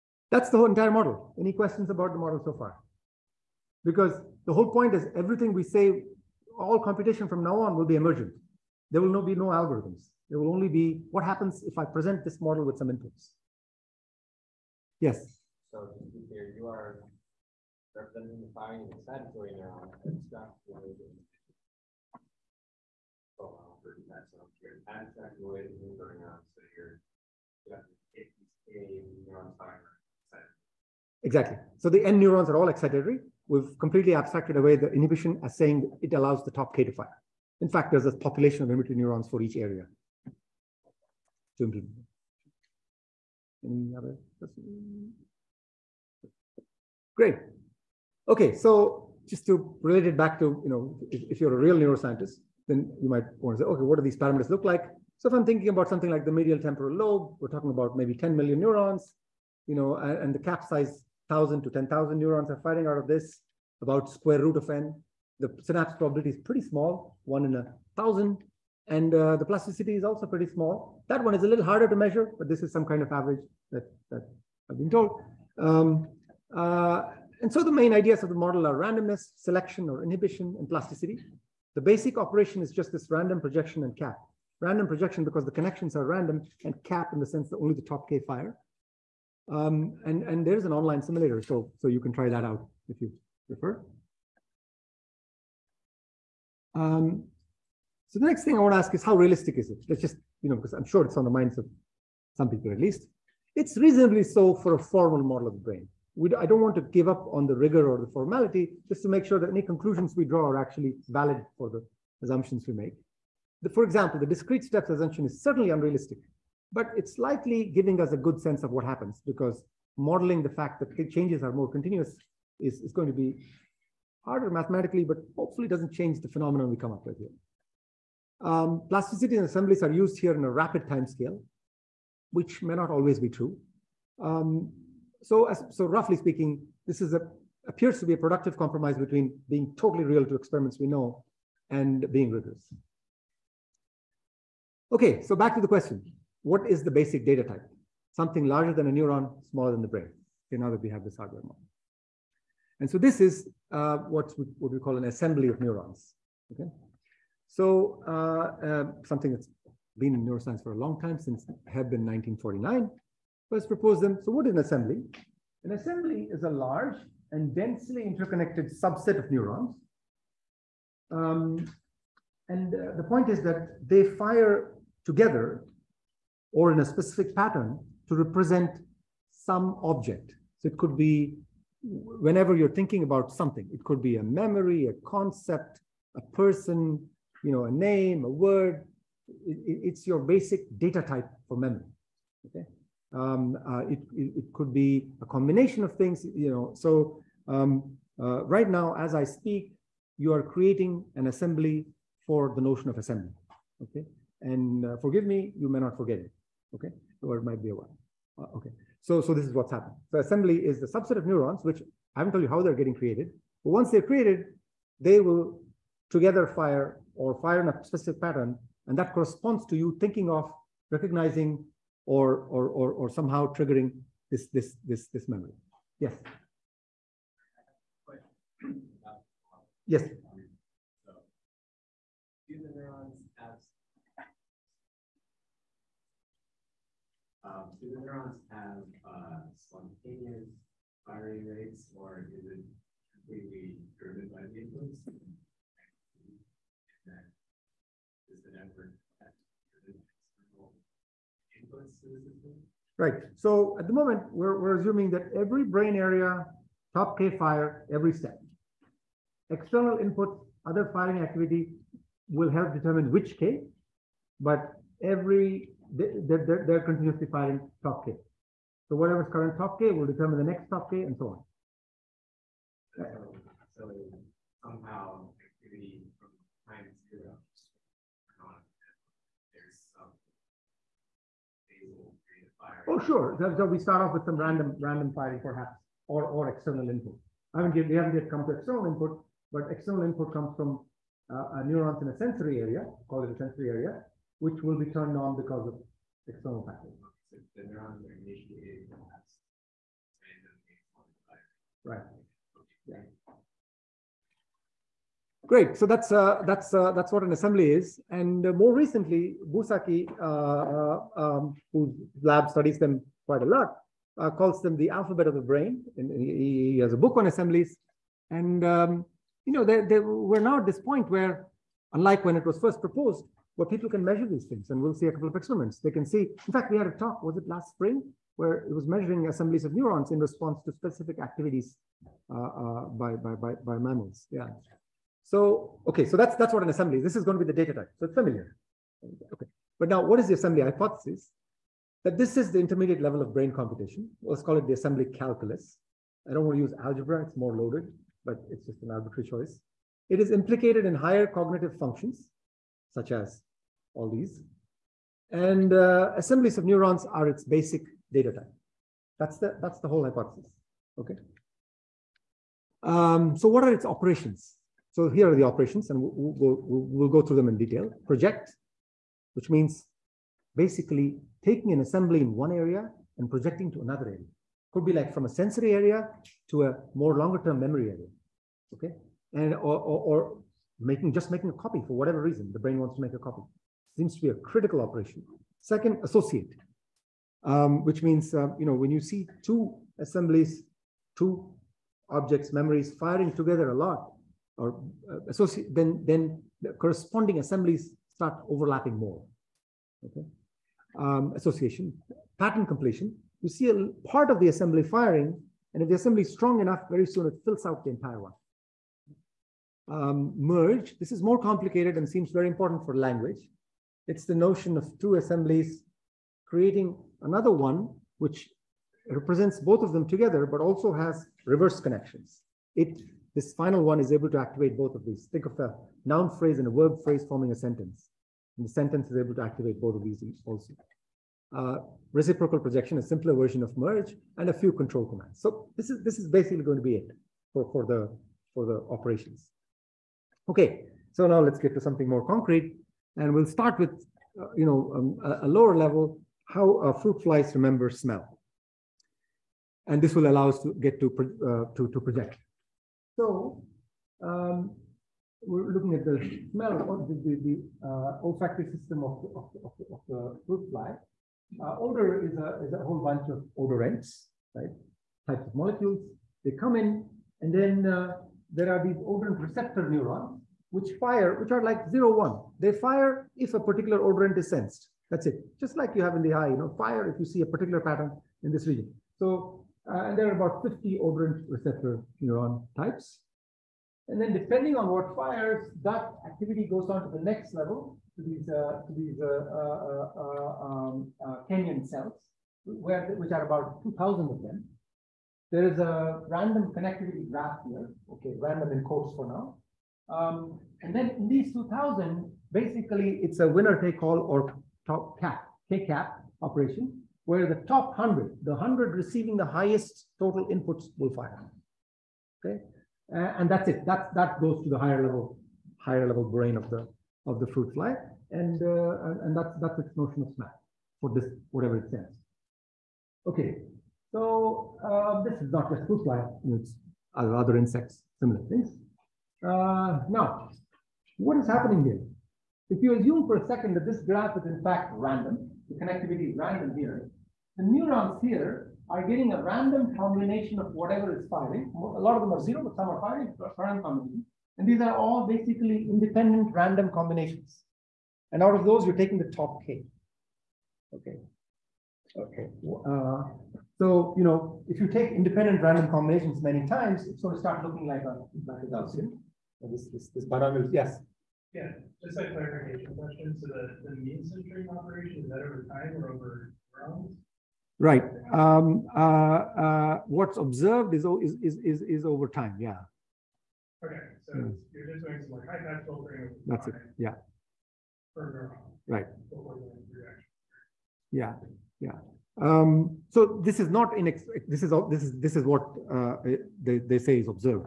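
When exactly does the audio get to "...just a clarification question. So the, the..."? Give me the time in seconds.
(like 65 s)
562 s.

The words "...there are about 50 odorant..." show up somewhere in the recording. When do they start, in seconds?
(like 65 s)
480 s.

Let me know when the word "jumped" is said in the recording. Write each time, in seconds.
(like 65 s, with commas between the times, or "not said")
not said.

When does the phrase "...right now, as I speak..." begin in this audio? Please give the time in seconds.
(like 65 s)
198 s.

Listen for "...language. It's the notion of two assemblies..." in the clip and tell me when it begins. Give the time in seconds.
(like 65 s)
412 s.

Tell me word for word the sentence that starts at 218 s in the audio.
And that corresponds to you thinking of recognizing or, or, or, or somehow triggering this, this, this, this memory.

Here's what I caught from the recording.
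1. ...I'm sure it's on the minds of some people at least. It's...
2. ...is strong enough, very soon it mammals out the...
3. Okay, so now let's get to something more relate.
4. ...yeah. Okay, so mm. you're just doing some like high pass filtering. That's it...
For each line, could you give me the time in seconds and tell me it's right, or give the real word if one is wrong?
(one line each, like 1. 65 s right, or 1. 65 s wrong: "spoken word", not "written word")
1. 100 s right
2. 406 s wrong: "fills", not "mammals"
3. 440 s wrong: "concrete", not "relate"
4. 572 s right.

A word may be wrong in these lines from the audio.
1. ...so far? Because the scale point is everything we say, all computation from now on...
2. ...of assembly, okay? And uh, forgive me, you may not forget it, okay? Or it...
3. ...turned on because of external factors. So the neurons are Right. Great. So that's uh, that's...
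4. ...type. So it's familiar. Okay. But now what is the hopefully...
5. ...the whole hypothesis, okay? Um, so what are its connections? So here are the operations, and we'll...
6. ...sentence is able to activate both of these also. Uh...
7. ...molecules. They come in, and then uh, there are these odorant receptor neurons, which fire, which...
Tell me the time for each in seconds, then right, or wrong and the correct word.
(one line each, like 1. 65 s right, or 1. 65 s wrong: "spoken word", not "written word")
1. 2 s wrong: "whole", not "scale"
2. 202 s right
3. 294 s right
4. 337 s wrong: "assembly", not "hopefully"
5. 359 s wrong: "operations", not "connections"
6. 428 s right
7. 465 s right.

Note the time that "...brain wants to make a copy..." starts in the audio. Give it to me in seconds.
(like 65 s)
382 s.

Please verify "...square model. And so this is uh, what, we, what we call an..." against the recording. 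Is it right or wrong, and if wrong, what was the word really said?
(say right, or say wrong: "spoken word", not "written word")
wrong: "hardware", not "square".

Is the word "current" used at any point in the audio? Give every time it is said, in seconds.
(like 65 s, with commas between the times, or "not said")
269 s.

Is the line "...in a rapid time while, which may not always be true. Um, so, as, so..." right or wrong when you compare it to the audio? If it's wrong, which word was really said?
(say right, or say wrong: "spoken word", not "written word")
wrong: "scale", not "while".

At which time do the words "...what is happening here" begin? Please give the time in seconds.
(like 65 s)
531 s.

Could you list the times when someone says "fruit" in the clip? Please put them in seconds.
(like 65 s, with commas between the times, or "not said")
446 s, 460 s, 517 s, 525 s.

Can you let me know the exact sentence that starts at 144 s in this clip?
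Okay, so back to the question.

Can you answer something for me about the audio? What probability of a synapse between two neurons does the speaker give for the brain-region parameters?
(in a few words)
one in a thousand.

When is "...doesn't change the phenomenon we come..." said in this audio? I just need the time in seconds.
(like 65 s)
125 s.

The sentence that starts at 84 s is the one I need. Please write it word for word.
Random projection because the connections are random and cap in the sense that only the top K fire.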